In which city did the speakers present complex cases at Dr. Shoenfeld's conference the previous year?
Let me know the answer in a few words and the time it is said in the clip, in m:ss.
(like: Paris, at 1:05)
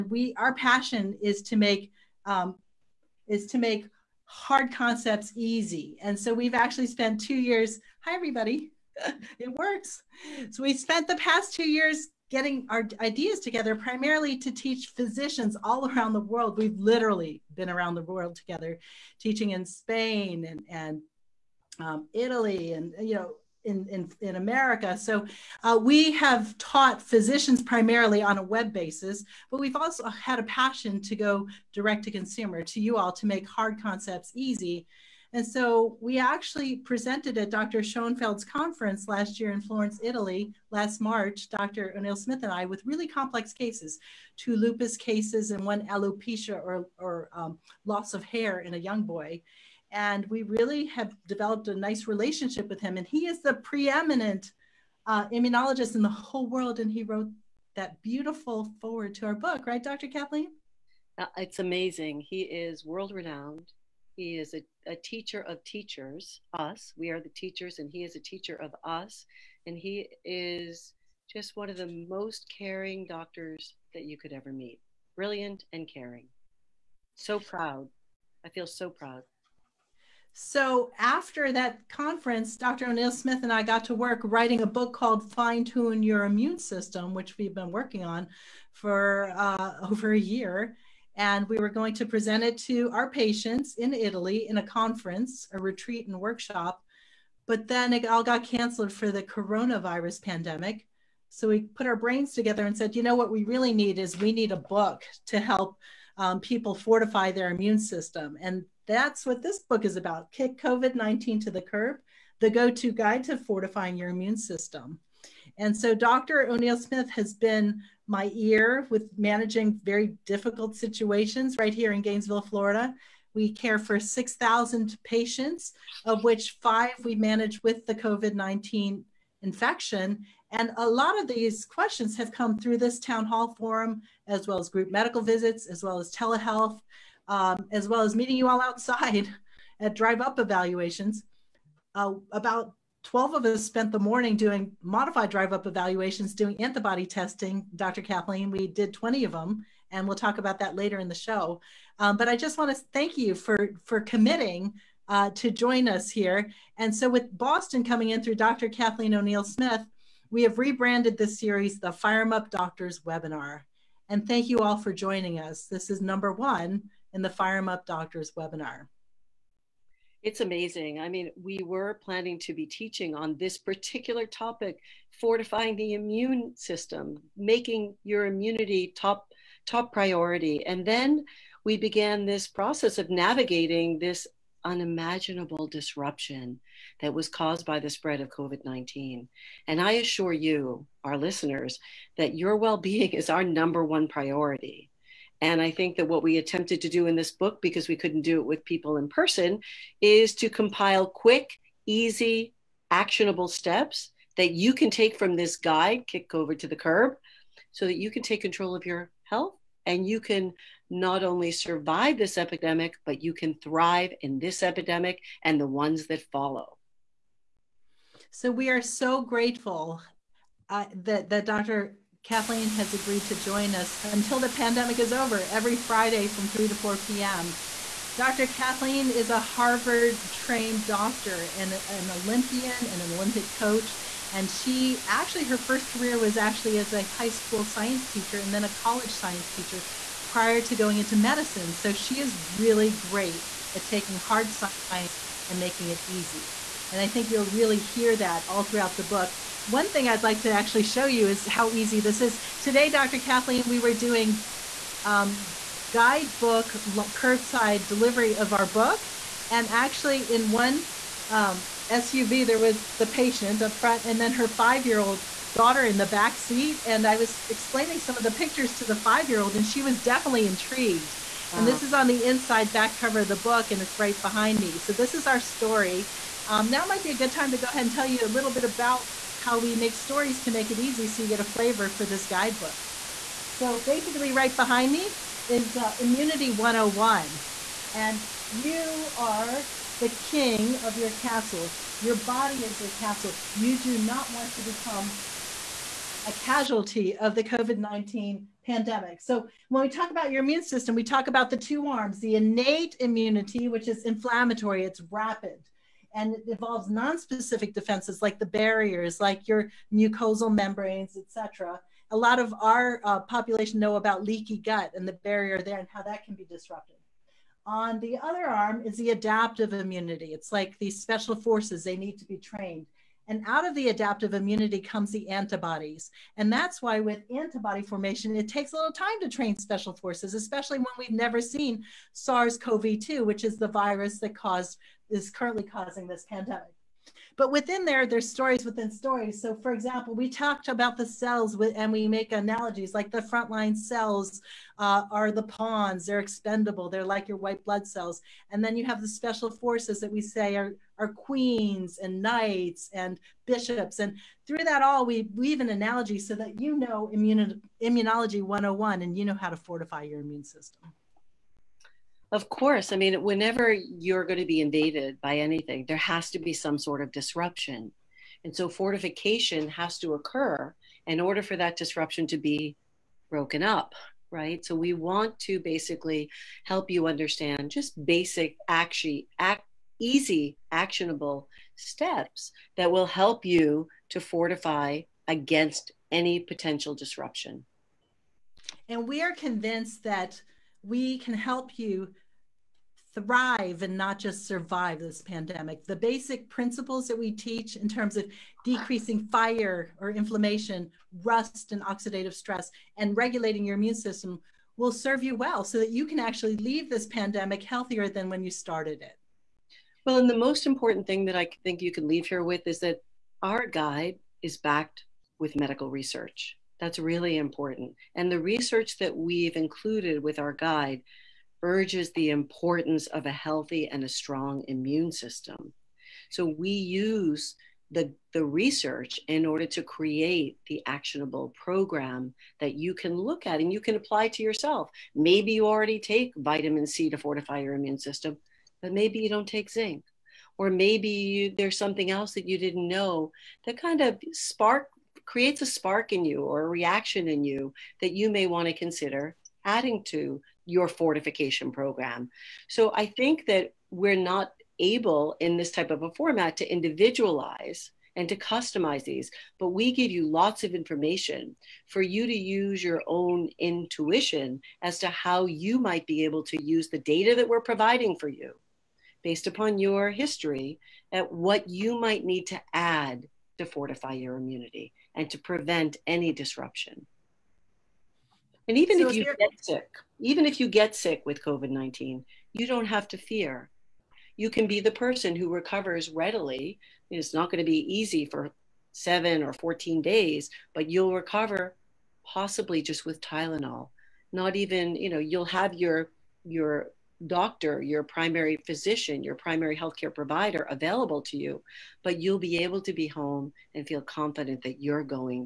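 Florence, at 0:39.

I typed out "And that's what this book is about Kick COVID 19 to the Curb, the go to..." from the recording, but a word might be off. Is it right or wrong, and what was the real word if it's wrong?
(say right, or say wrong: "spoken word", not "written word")
right.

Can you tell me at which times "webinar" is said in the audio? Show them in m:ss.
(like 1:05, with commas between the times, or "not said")
2:43, 2:48.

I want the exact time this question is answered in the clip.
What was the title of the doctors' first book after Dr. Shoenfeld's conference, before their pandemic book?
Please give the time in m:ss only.
1:25.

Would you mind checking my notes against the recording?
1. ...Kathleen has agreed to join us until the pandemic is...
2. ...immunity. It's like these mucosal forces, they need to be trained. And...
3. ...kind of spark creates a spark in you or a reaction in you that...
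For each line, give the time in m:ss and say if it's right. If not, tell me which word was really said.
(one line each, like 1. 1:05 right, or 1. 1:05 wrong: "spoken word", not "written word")
1. 3:42 right
2. 5:19 wrong: "special", not "mucosal"
3. 7:23 right.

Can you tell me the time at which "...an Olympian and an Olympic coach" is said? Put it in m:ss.
3:51.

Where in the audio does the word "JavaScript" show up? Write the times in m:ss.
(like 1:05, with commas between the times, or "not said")
not said.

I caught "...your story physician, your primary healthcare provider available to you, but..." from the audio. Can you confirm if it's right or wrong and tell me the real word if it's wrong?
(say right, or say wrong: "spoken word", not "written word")
wrong: "primary", not "story".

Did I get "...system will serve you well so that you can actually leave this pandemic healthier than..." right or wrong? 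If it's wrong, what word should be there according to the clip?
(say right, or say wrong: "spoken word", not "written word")
right.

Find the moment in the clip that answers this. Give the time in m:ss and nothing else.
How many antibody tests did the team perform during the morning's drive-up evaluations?
2:28.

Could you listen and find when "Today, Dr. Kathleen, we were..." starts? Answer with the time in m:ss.
4:12.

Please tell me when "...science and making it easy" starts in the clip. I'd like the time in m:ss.
4:04.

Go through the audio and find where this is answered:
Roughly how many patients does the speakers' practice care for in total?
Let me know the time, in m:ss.
2:03.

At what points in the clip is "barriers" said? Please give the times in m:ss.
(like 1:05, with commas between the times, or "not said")
5:08, 5:15.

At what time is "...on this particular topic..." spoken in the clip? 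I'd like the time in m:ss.
2:53.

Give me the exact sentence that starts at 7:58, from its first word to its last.
And even so if, if you get sick, even if you get sick with COVID 19, you don't have to fear.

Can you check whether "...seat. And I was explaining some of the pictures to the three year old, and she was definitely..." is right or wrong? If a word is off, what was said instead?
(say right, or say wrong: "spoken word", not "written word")
wrong: "five", not "three".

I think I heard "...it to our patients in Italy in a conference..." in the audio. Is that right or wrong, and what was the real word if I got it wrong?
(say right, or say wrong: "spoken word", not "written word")
right.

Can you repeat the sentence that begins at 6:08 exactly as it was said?
And so fortification has to occur in order for that disruption to be broken up, right?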